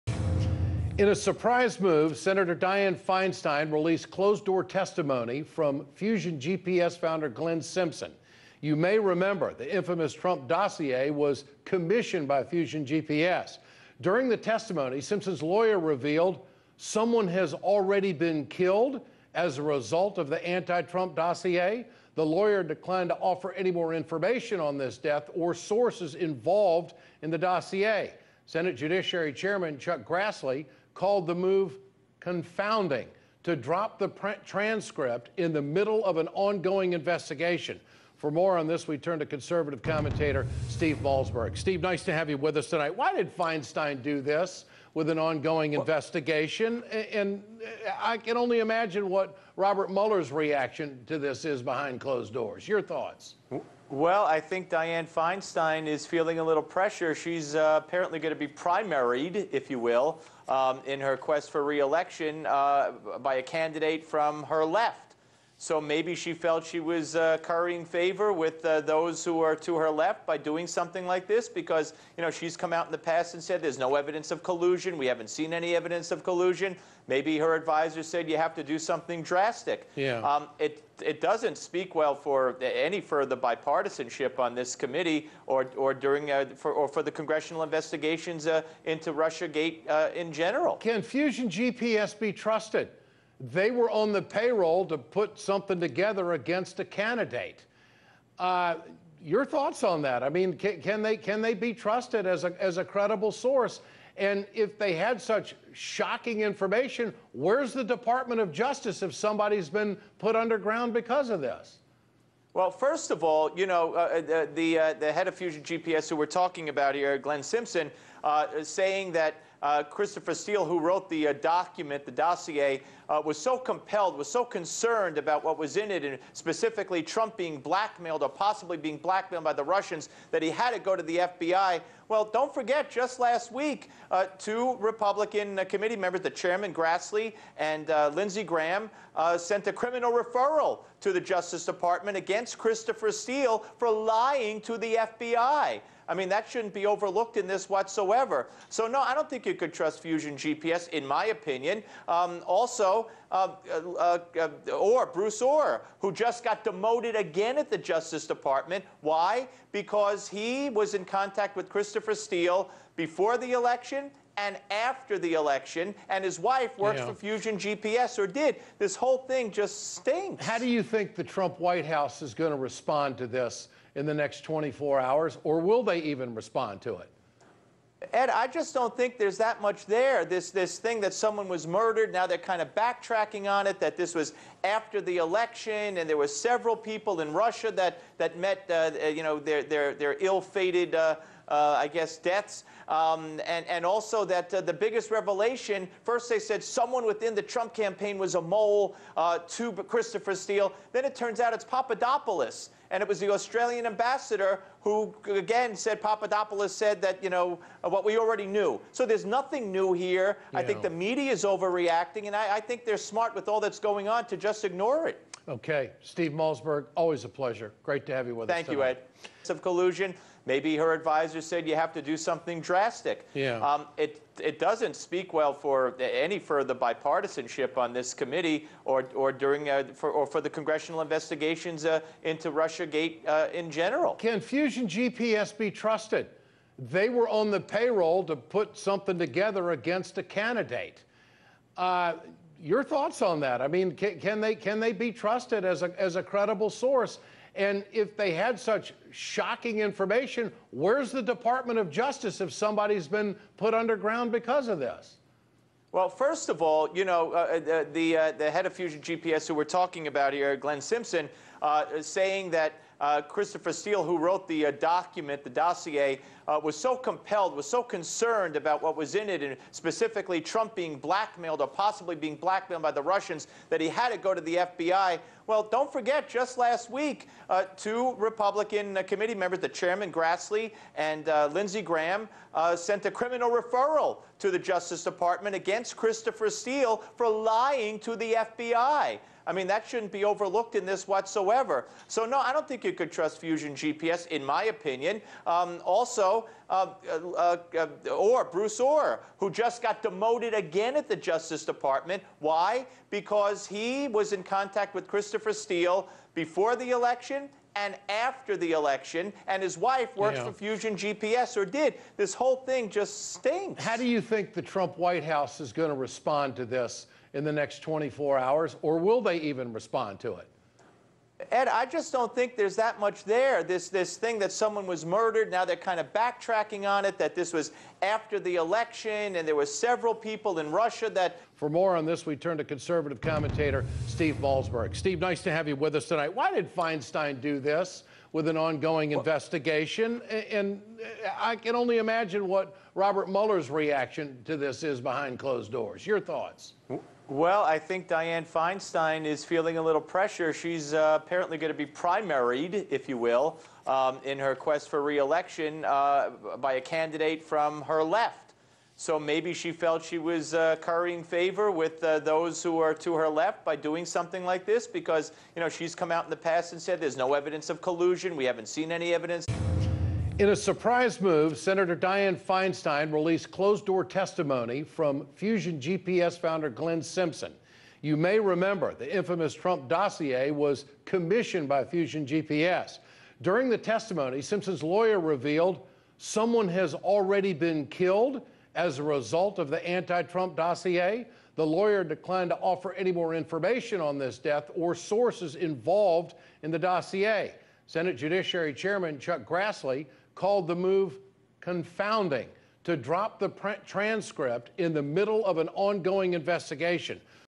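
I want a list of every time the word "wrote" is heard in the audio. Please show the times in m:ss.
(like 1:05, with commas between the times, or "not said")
2:00, 4:24.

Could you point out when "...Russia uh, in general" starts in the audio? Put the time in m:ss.
3:52.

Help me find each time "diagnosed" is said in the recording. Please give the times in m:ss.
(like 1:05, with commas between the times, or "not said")
not said.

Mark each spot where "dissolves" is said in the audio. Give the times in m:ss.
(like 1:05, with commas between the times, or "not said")
not said.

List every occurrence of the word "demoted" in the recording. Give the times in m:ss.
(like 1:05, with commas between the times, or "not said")
2:36, 5:00.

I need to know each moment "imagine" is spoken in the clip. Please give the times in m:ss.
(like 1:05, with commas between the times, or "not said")
0:48, 5:41.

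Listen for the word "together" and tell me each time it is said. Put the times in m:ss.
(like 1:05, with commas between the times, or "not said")
1:35, 3:59.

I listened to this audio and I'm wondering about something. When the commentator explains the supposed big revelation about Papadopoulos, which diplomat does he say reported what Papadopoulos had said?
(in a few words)
Australian ambassador.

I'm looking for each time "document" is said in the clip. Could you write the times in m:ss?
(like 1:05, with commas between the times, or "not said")
2:01, 4:24.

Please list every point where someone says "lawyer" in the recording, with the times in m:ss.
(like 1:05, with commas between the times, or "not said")
0:15, 0:22, 6:24, 6:31.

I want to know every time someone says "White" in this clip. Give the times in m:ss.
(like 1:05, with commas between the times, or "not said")
2:51, 5:14.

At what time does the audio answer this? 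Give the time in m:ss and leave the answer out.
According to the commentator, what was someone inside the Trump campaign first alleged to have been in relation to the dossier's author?
3:18.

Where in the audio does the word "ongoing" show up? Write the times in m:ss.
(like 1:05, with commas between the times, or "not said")
0:36, 0:45, 5:38, 6:45.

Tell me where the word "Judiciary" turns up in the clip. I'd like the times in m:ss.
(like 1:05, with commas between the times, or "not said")
0:28, 6:38.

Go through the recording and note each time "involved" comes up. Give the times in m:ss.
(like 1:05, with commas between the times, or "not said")
0:26, 6:35.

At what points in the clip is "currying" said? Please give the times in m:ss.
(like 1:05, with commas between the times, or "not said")
1:07, 6:00.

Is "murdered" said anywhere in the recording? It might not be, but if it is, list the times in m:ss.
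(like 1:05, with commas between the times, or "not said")
3:01, 5:25.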